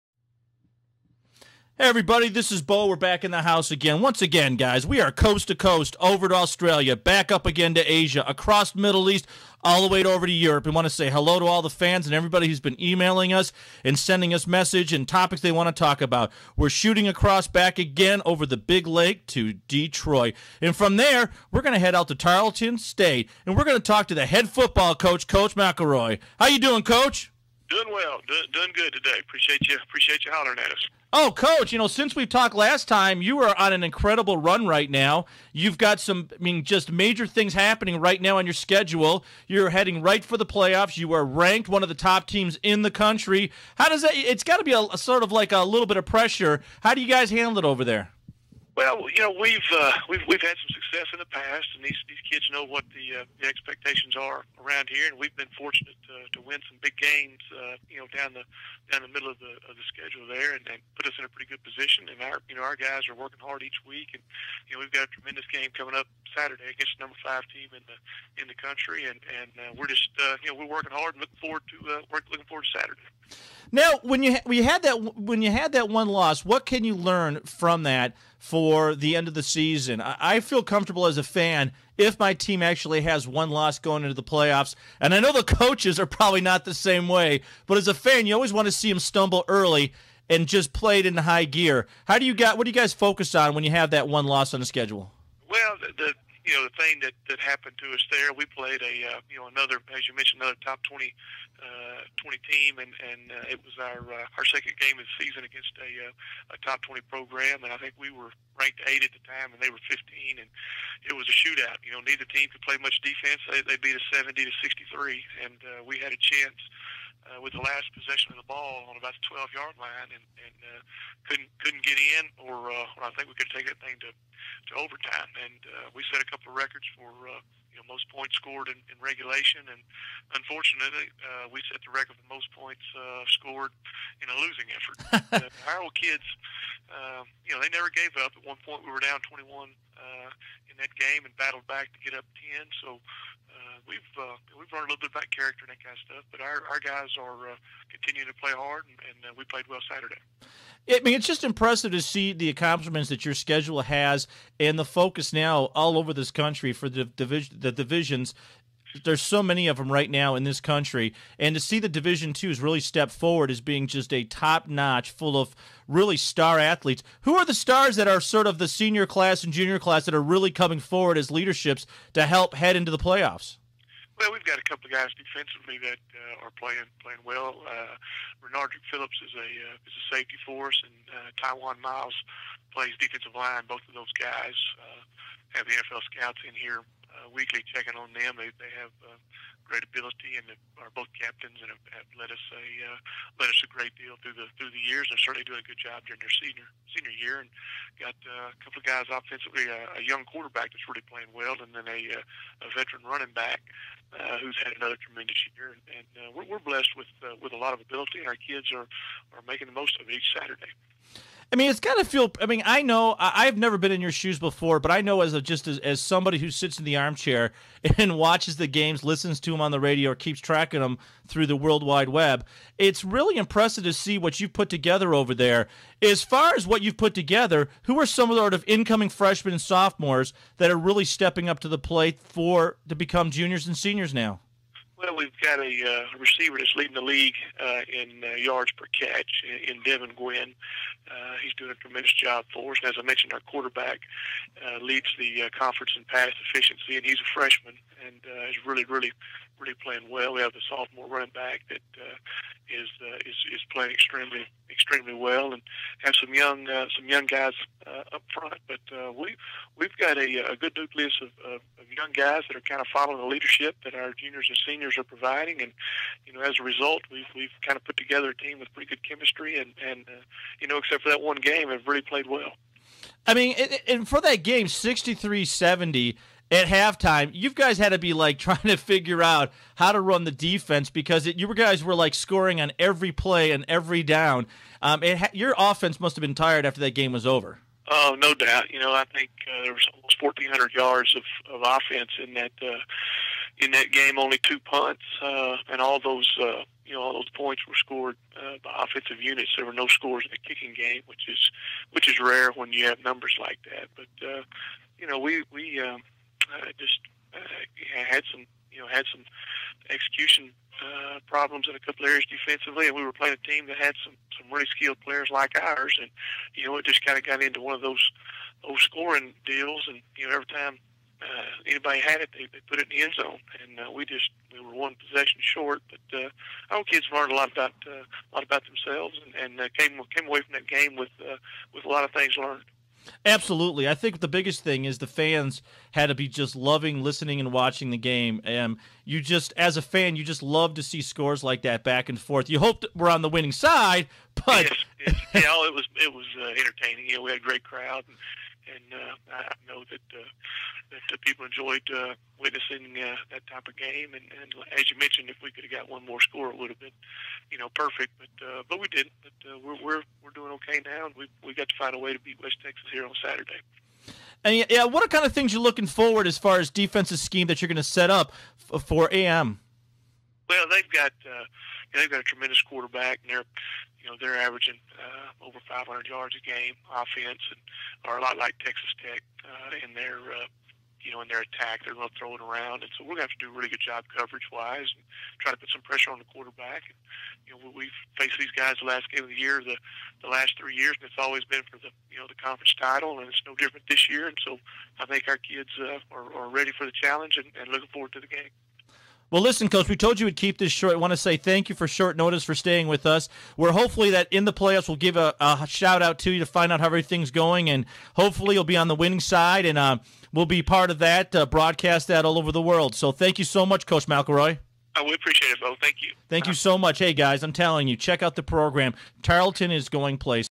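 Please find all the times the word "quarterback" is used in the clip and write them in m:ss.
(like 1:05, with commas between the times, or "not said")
3:20, 4:03, 6:12, 6:26.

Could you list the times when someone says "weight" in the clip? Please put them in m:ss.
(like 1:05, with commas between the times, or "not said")
not said.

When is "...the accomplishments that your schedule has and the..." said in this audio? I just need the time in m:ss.
2:32.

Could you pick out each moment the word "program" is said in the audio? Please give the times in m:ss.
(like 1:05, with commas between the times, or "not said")
1:47, 6:58.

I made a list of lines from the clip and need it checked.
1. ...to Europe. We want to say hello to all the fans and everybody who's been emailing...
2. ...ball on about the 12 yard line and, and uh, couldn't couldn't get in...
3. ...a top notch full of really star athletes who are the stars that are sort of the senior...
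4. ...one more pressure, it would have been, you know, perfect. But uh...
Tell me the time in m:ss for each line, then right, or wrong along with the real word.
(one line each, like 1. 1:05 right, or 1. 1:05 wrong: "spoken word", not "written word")
1. 0:10 right
2. 1:58 right
3. 2:44 right
4. 5:55 wrong: "score", not "pressure".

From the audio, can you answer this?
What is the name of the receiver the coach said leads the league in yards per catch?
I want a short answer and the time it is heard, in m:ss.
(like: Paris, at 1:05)
Devin Gwynn, at 3:59.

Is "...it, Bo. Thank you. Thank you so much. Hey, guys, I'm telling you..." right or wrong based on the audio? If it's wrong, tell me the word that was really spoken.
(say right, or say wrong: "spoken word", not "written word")
right.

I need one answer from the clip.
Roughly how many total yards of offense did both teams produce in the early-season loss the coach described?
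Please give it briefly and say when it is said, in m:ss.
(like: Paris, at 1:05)
1,400, at 4:50.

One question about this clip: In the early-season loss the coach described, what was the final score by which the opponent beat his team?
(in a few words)
70 to 63.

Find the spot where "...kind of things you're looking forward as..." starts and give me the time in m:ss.
6:05.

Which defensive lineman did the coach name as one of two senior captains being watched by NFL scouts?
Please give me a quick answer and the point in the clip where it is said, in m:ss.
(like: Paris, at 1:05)
Taiwan Miles, at 3:01.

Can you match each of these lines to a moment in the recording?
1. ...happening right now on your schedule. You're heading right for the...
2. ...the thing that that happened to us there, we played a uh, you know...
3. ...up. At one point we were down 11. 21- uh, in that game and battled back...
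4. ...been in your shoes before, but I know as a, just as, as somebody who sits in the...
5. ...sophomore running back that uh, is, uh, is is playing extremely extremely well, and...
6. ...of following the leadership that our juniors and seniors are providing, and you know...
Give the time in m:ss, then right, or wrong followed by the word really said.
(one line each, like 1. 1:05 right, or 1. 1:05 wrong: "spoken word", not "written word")
1. 0:37 right
2. 1:36 right
3. 2:18 wrong: "21", not "11"
4. 3:33 right
5. 4:10 right
6. 4:22 right.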